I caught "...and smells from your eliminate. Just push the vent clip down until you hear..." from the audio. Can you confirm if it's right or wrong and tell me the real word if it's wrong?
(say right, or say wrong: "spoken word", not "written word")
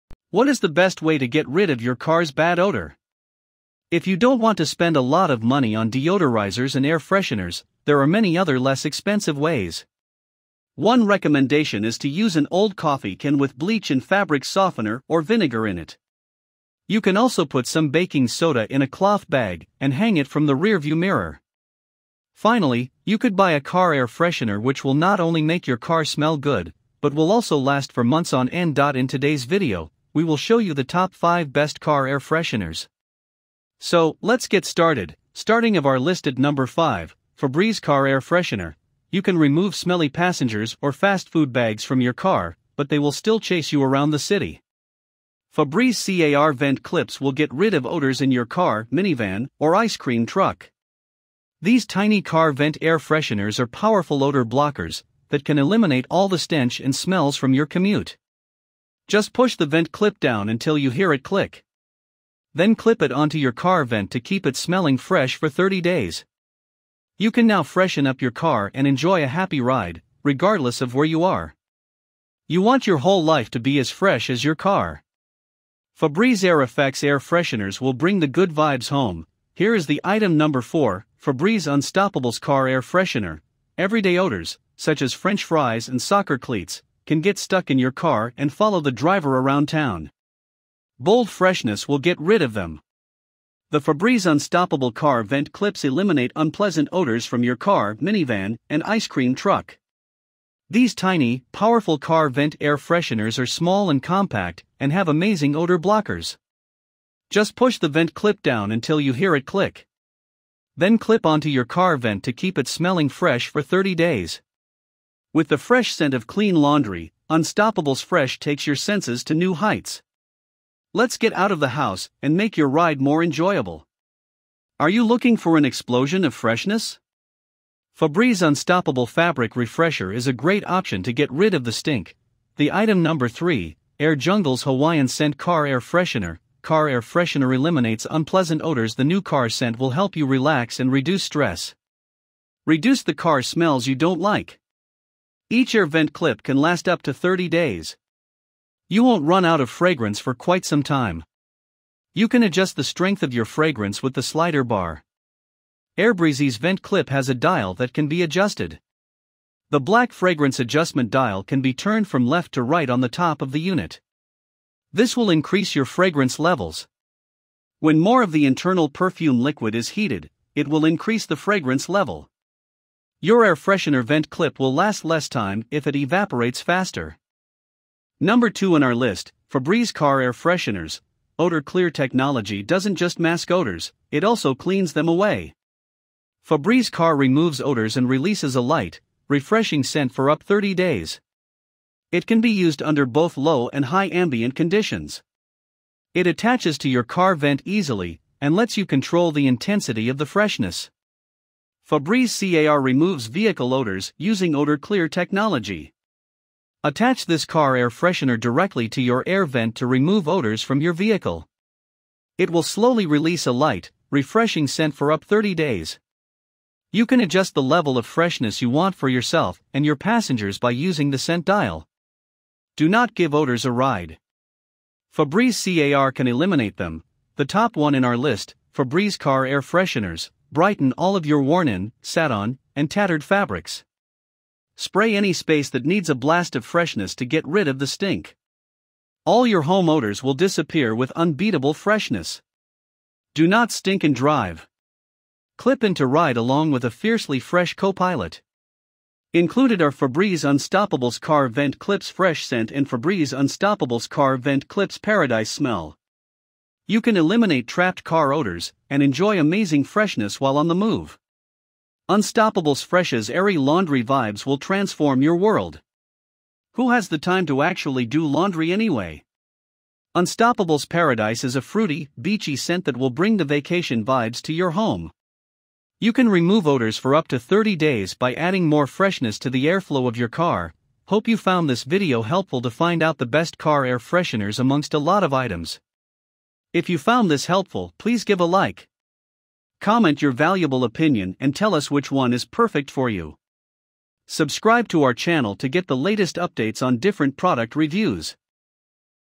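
wrong: "commute", not "eliminate".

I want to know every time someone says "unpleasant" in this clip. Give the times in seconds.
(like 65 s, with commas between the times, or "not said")
96 s, 138 s.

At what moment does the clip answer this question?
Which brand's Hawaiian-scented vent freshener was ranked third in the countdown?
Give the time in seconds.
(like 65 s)
134 s.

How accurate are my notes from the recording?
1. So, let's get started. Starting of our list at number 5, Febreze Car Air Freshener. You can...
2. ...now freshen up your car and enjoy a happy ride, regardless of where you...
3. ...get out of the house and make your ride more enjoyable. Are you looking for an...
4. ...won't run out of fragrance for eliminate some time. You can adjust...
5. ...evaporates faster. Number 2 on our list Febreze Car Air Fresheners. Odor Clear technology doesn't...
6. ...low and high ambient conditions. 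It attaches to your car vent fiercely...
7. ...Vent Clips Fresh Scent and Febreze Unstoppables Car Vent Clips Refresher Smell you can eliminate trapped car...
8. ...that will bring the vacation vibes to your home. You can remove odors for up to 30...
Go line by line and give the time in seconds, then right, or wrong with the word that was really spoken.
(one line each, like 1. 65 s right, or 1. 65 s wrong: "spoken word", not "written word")
1. 33 s right
2. 67 s right
3. 121 s right
4. 149 s wrong: "quite", not "eliminate"
5. 175 s right
6. 193 s wrong: "easily", not "fiercely"
7. 251 s wrong: "Paradise", not "Refresher"
8. 272 s right.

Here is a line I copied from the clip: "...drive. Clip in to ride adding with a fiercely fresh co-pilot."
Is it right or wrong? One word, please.
wrong.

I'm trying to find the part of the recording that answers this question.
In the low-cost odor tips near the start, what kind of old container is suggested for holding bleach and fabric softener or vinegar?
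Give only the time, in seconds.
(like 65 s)
12 s.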